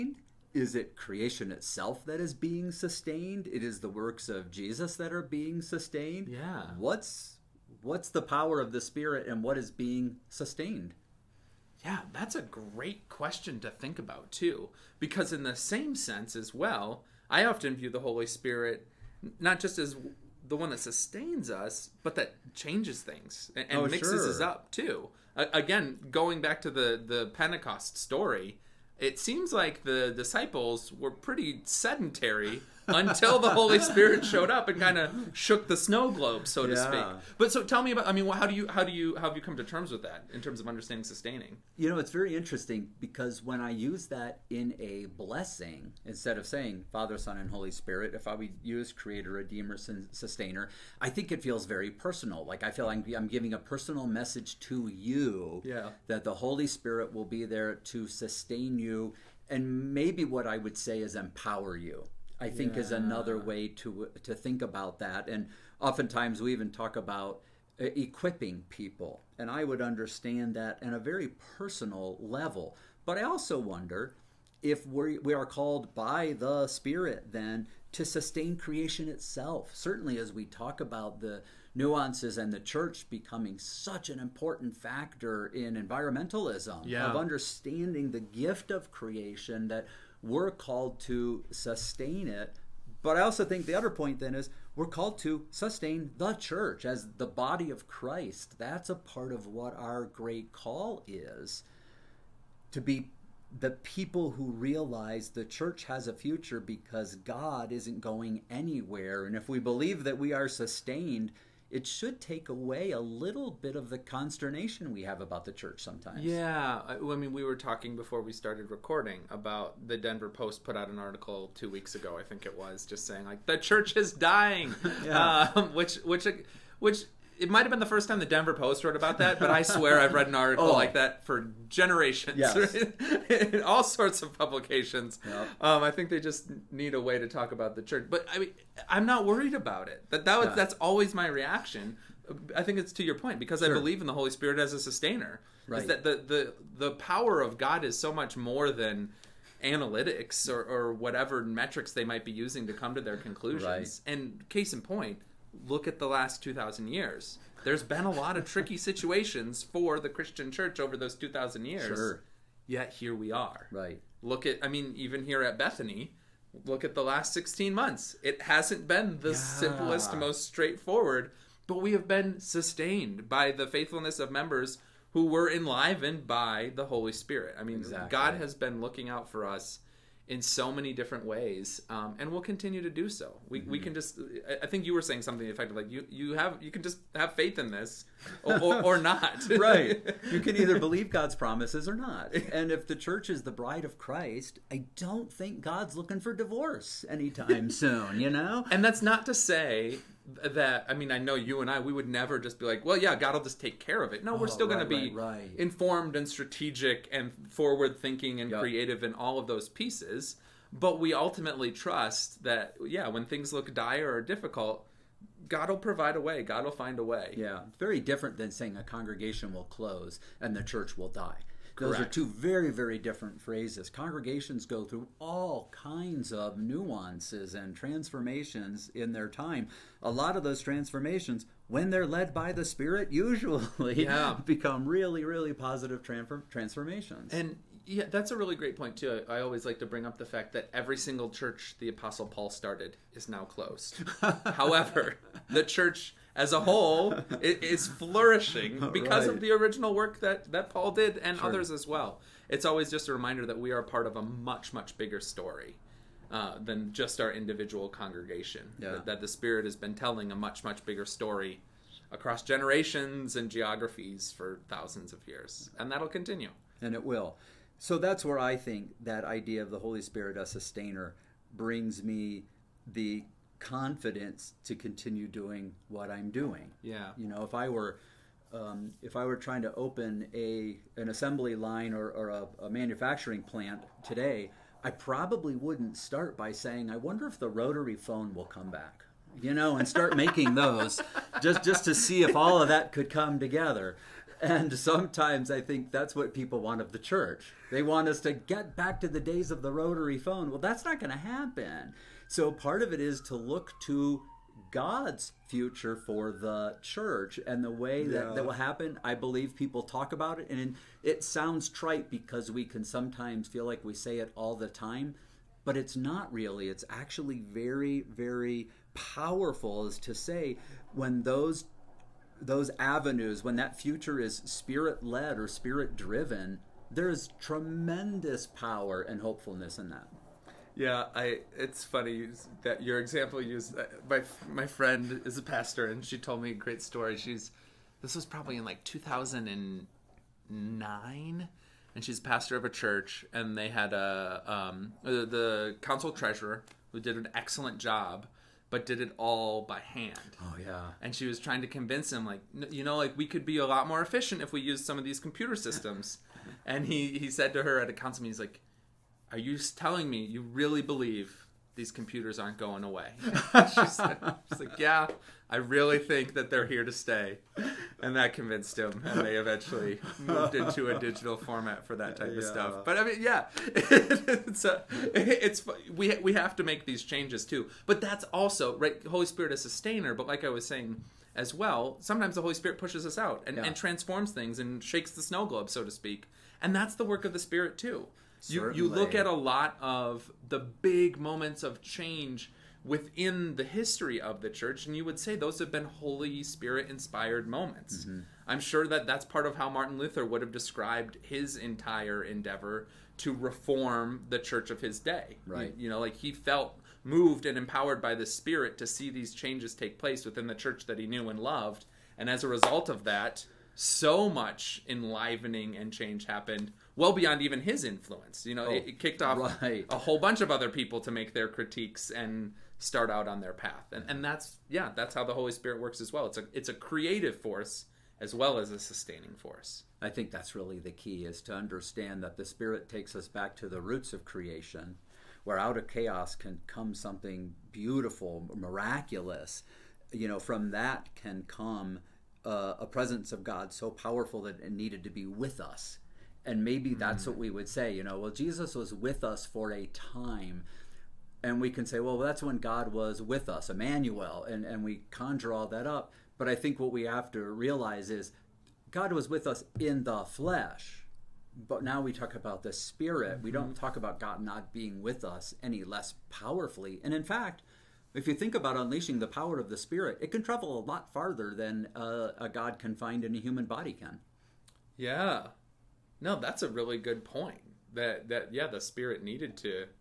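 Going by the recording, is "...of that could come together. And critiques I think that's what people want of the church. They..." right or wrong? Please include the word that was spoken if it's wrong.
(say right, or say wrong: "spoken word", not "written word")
wrong: "sometimes", not "critiques".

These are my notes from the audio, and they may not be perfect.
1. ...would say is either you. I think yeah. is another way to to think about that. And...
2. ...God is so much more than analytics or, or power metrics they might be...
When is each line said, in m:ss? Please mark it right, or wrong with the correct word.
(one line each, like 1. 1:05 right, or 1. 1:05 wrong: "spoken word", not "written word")
1. 1:00 wrong: "empower", not "either"
2. 2:27 wrong: "whatever", not "power".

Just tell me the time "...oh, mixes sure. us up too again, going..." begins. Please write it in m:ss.
0:23.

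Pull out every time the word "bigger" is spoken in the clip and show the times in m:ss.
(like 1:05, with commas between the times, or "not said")
4:14, 4:20.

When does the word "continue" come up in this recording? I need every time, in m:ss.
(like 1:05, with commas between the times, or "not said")
3:02, 4:26, 4:34.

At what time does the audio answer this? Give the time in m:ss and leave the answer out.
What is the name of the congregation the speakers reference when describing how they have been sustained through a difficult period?
2:45.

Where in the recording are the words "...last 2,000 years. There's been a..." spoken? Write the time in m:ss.
2:36.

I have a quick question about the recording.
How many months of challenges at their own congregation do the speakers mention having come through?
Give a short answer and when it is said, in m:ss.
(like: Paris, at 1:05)
16, at 2:47.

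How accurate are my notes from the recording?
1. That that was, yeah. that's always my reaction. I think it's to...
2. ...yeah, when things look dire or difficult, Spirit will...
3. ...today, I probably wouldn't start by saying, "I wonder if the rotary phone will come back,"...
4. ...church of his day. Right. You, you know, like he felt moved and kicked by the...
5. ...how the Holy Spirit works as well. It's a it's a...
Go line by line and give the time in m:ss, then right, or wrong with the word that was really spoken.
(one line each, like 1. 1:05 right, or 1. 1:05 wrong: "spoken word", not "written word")
1. 2:20 right
2. 3:32 wrong: "God", not "Spirit"
3. 4:44 right
4. 6:44 wrong: "empowered", not "kicked"
5. 7:05 right.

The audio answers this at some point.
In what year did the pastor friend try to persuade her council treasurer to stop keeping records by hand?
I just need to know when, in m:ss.
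5:38.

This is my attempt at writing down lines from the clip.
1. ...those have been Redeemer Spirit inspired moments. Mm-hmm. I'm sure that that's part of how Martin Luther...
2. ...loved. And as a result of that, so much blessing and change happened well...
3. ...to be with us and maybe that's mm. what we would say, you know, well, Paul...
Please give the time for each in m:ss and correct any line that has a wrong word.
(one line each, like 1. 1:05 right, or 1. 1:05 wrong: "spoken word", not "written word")
1. 6:35 wrong: "Holy", not "Redeemer"
2. 6:51 wrong: "enlivening", not "blessing"
3. 7:25 wrong: "Jesus", not "Paul".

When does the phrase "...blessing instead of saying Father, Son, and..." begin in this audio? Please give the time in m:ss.
0:45.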